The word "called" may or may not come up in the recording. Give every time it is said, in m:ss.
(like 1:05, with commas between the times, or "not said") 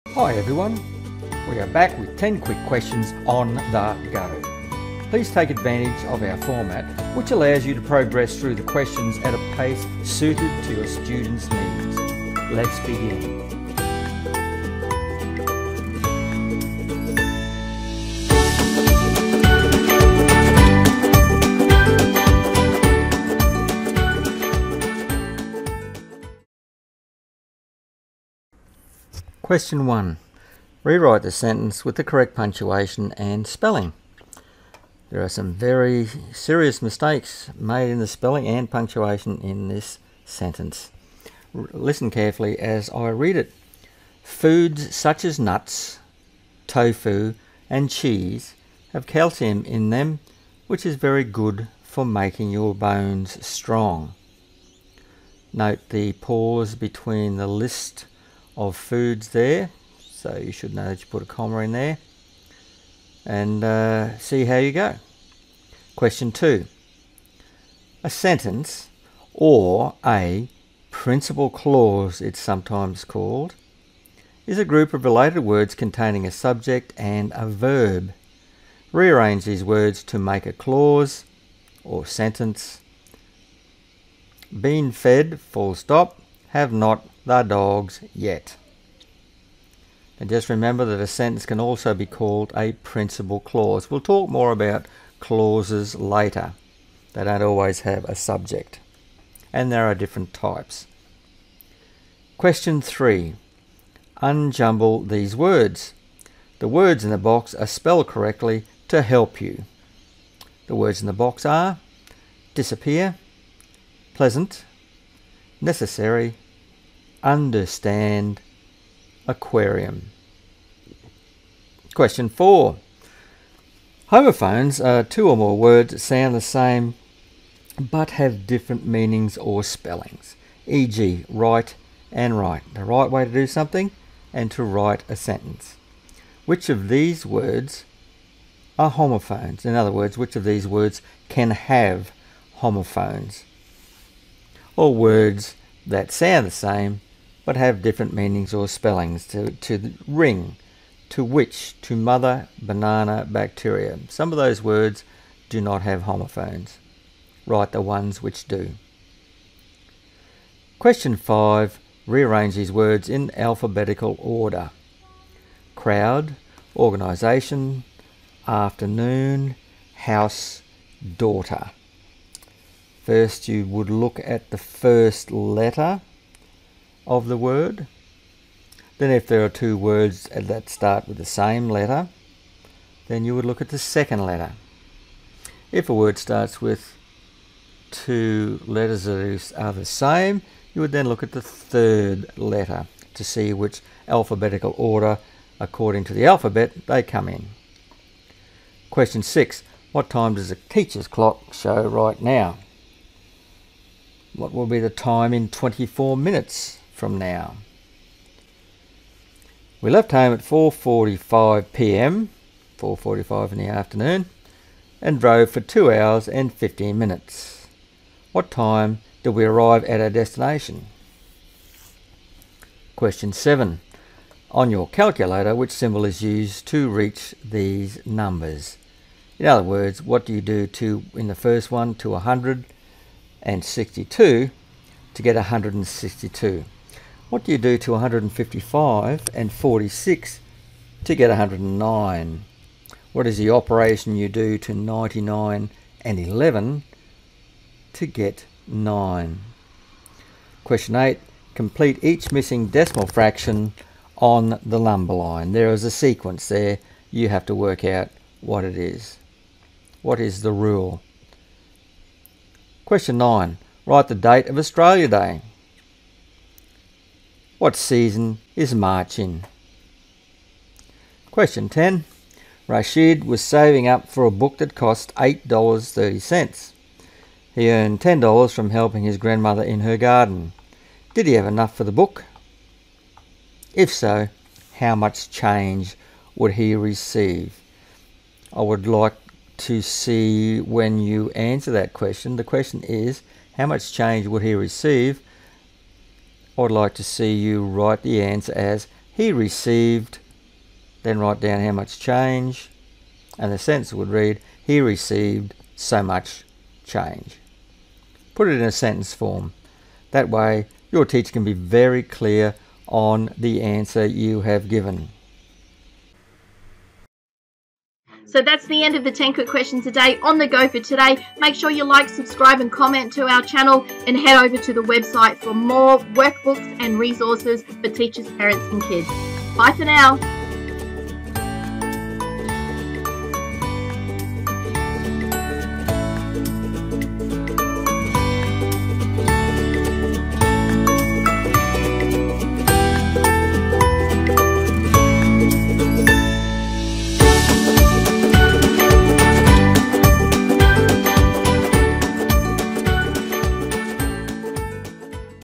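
1:13, 1:32.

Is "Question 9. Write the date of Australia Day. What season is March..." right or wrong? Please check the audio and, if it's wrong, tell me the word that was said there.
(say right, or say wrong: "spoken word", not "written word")
right.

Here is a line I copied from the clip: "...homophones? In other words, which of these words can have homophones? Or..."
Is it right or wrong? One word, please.
right.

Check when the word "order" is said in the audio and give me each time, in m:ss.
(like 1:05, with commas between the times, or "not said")
2:44, 3:14.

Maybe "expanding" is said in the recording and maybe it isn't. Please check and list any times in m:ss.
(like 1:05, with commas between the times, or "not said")
not said.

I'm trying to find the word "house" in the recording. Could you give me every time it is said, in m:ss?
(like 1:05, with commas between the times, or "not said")
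2:49.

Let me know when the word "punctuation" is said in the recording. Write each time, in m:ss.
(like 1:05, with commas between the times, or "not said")
0:32, 0:38.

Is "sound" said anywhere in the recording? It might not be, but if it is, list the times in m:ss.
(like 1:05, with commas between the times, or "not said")
2:05, 2:26.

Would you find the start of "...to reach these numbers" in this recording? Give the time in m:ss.
3:46.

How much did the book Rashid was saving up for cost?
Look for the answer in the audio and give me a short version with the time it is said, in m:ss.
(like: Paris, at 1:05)
$8.30, at 4:35.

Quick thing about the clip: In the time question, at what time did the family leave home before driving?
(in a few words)
4:45 p.m.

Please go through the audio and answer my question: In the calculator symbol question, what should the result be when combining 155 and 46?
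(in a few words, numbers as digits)
109.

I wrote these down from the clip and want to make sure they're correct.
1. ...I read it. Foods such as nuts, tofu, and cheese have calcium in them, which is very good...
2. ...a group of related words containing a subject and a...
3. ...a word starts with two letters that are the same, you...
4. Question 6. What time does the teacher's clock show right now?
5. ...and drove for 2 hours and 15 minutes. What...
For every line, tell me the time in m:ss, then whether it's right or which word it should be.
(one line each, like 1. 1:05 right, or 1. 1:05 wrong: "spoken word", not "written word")
1. 0:42 right
2. 1:14 right
3. 3:05 right
4. 3:18 right
5. 3:35 right.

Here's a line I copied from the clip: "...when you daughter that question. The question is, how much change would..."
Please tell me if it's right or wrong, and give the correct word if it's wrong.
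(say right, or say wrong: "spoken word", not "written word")
wrong: "answer", not "daughter".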